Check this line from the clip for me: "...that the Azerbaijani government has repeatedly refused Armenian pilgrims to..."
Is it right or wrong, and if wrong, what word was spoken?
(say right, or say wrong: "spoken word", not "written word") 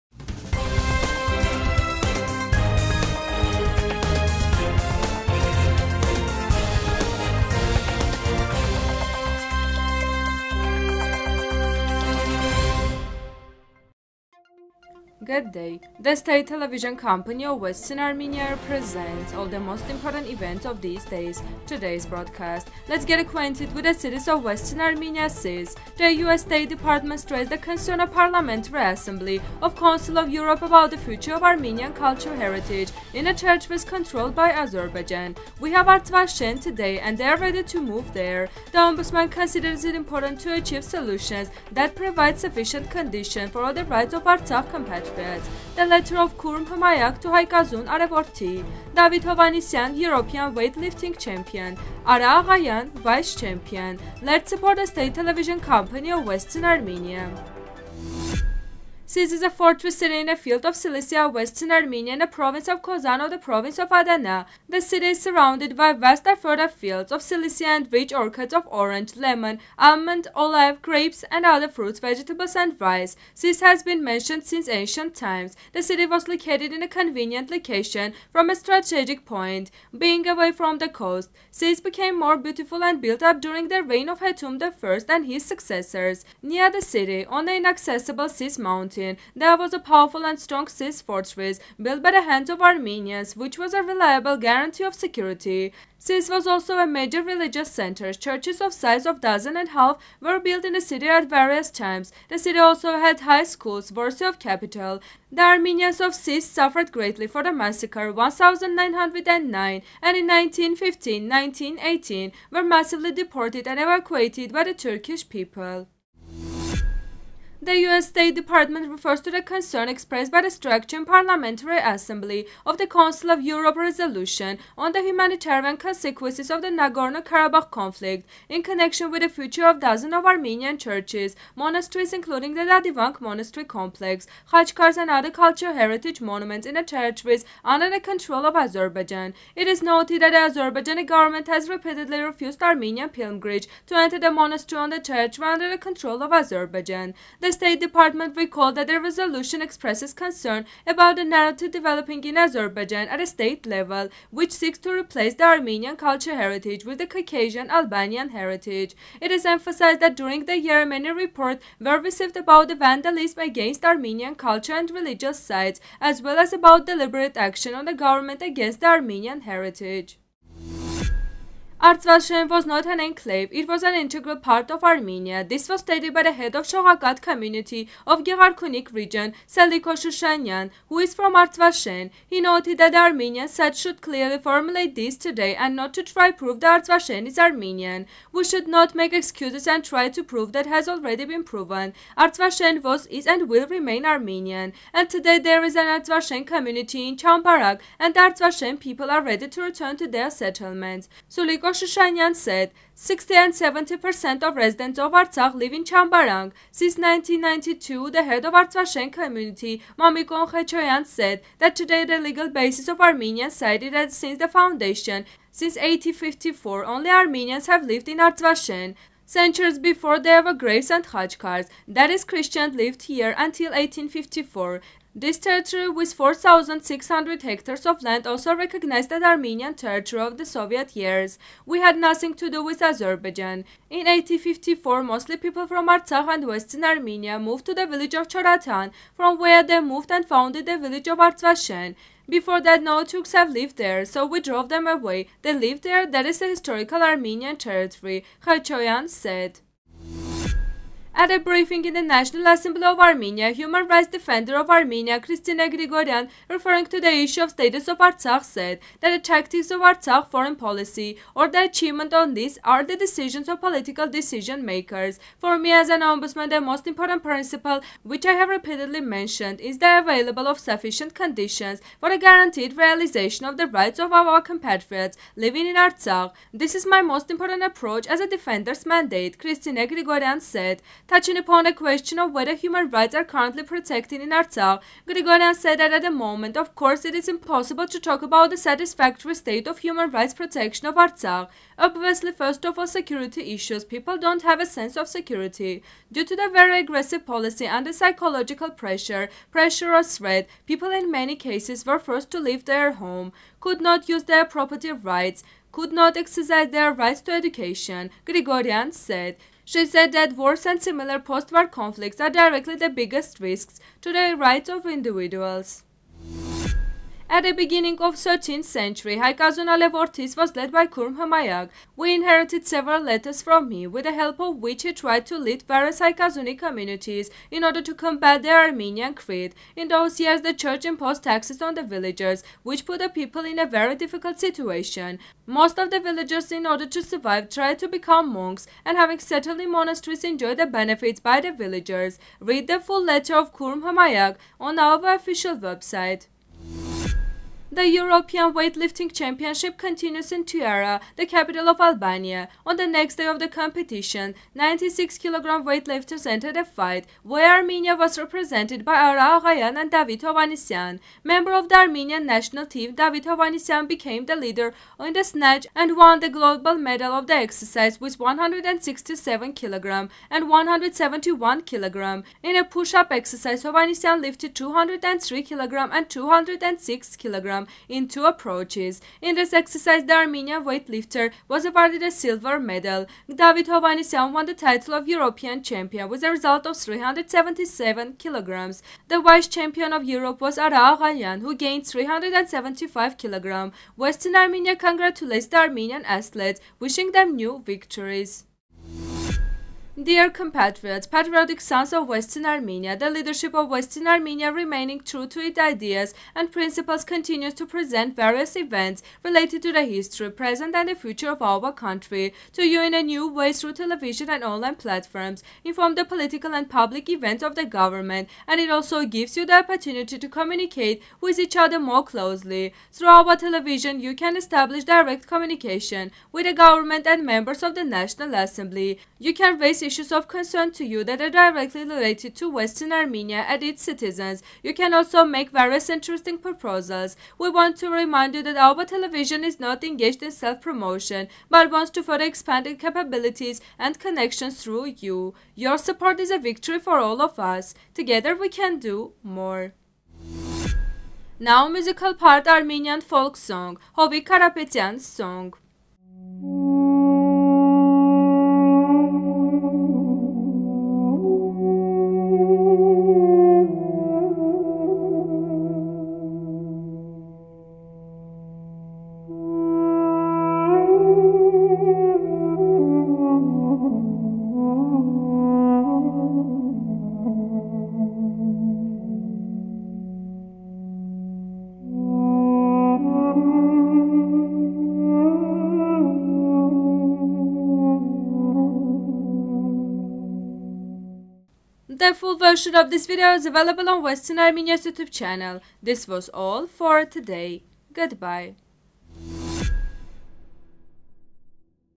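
right.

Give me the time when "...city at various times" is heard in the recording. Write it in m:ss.
1:40.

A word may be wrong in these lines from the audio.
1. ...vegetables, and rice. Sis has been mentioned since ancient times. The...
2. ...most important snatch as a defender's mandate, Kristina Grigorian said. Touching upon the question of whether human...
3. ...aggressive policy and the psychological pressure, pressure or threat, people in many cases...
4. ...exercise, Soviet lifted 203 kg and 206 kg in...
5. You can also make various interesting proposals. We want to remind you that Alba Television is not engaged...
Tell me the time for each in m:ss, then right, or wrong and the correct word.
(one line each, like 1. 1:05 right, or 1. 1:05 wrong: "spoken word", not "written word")
1. 1:11 right
2. 4:37 wrong: "approach", not "snatch"
3. 4:56 right
4. 6:13 wrong: "Hovhannisyan", not "Soviet"
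5. 7:14 right.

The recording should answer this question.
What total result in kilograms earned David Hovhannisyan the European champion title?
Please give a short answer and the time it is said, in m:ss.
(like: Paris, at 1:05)
377 kilograms, at 6:26.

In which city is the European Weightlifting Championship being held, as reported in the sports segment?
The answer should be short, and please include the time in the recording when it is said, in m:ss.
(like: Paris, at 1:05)
Tirana, at 5:50.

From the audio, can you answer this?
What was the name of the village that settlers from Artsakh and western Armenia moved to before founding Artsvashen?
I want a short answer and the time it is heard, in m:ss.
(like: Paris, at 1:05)
Choratan, at 3:58.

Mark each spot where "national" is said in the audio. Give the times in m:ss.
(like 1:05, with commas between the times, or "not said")
4:12, 6:02, 7:07.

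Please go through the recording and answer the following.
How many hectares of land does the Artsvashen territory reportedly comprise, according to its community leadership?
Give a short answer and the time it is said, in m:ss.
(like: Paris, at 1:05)
4,600, at 3:46.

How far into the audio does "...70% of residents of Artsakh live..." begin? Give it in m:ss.
3:23.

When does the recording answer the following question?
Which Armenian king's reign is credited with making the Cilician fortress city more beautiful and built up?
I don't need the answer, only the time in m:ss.
1:24.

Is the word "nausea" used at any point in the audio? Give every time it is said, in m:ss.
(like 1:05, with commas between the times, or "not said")
not said.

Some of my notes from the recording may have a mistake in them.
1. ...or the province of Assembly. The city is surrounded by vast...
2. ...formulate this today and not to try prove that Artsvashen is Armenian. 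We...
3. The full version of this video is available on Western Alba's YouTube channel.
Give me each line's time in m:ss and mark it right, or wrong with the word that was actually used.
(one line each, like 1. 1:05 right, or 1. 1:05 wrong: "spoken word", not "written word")
1. 1:03 wrong: "Adana", not "Assembly"
2. 3:04 right
3. 8:12 wrong: "Armenia", not "Alba".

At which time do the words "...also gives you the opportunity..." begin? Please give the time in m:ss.
6:58.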